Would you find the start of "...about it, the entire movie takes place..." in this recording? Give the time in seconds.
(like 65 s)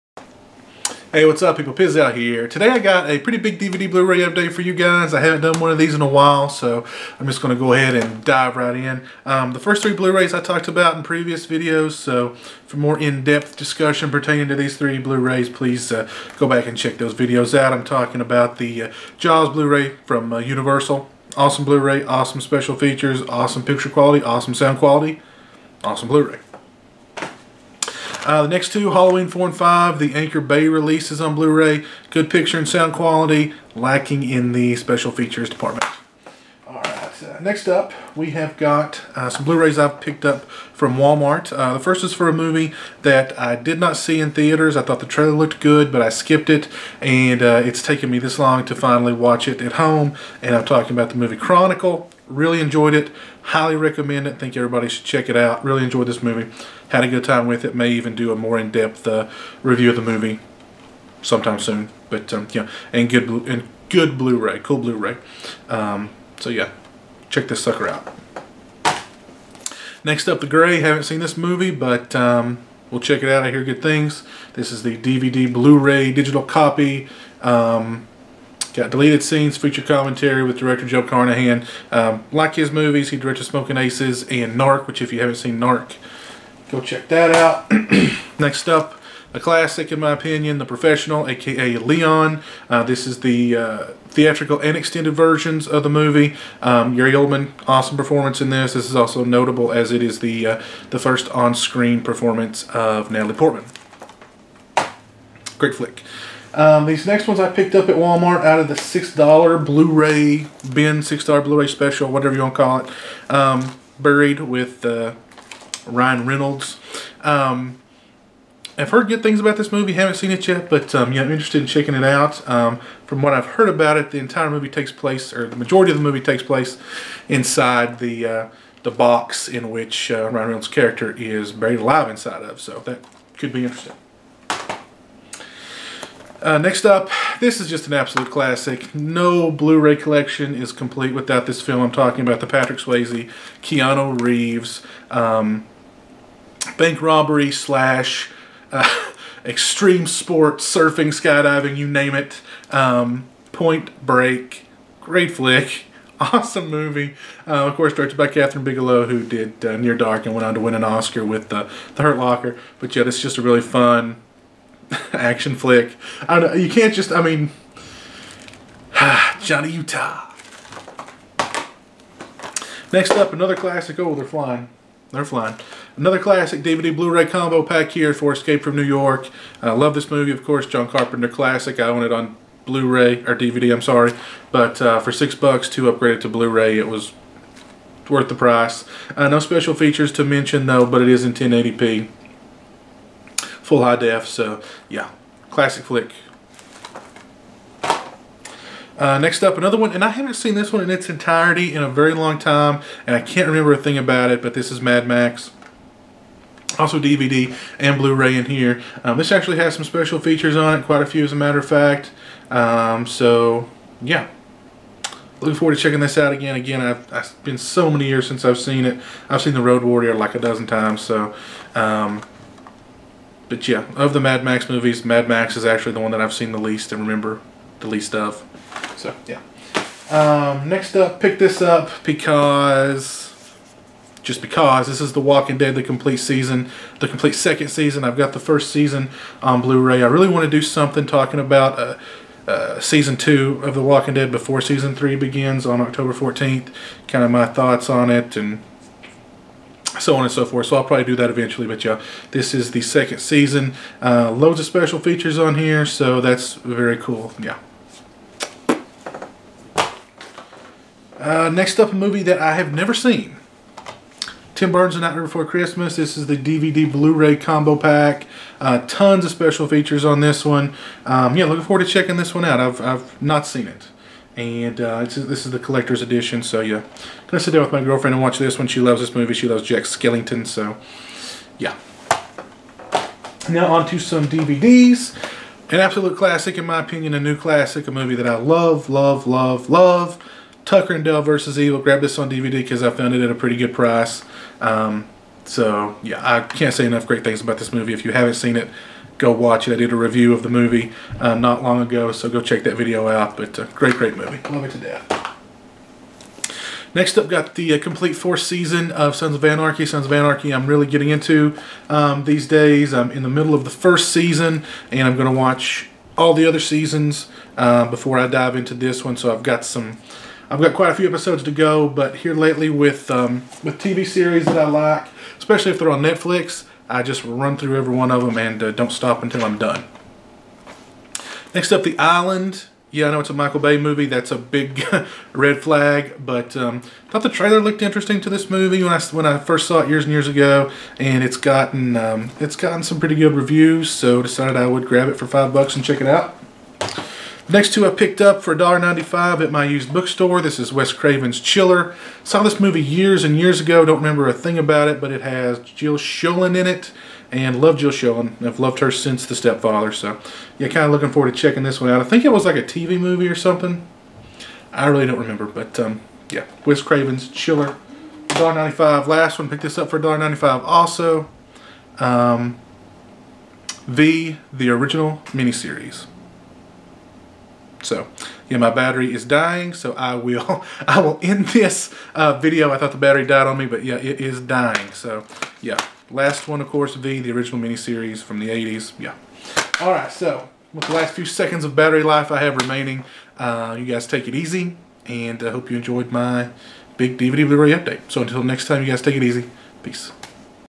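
123 s.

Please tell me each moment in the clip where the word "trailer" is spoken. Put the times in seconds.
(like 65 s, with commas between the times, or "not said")
45 s, 337 s.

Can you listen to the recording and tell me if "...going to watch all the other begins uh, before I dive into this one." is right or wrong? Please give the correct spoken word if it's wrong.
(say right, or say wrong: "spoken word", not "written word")
wrong: "seasons", not "begins".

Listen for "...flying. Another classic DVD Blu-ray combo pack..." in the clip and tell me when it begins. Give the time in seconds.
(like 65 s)
175 s.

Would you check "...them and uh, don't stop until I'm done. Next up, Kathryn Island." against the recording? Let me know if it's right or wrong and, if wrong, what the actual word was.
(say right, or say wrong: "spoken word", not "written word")
wrong: "The", not "Kathryn".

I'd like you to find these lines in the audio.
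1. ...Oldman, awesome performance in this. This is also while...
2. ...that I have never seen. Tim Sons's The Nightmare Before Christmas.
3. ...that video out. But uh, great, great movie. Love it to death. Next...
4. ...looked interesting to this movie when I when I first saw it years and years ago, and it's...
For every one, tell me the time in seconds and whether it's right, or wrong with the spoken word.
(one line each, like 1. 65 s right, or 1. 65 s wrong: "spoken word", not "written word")
1. 97 s wrong: "notable", not "while"
2. 262 s wrong: "Burton", not "Sons"
3. 302 s right
4. 337 s right.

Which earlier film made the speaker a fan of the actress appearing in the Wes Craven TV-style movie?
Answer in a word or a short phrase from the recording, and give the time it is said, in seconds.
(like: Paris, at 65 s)
The Stepfather, at 359 s.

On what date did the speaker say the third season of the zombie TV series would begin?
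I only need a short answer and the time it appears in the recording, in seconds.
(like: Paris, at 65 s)
October 14th, at 245 s.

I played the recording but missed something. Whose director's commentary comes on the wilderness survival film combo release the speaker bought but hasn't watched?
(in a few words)
Joe Carnahan.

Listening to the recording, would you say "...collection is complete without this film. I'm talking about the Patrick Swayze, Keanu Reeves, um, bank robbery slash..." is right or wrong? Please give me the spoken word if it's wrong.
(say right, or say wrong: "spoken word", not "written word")
right.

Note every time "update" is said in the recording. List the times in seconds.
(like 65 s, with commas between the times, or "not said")
4 s, 397 s.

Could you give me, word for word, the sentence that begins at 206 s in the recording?
Also DVD and Blu-ray in here.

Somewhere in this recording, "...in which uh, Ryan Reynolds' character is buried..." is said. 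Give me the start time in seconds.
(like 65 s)
129 s.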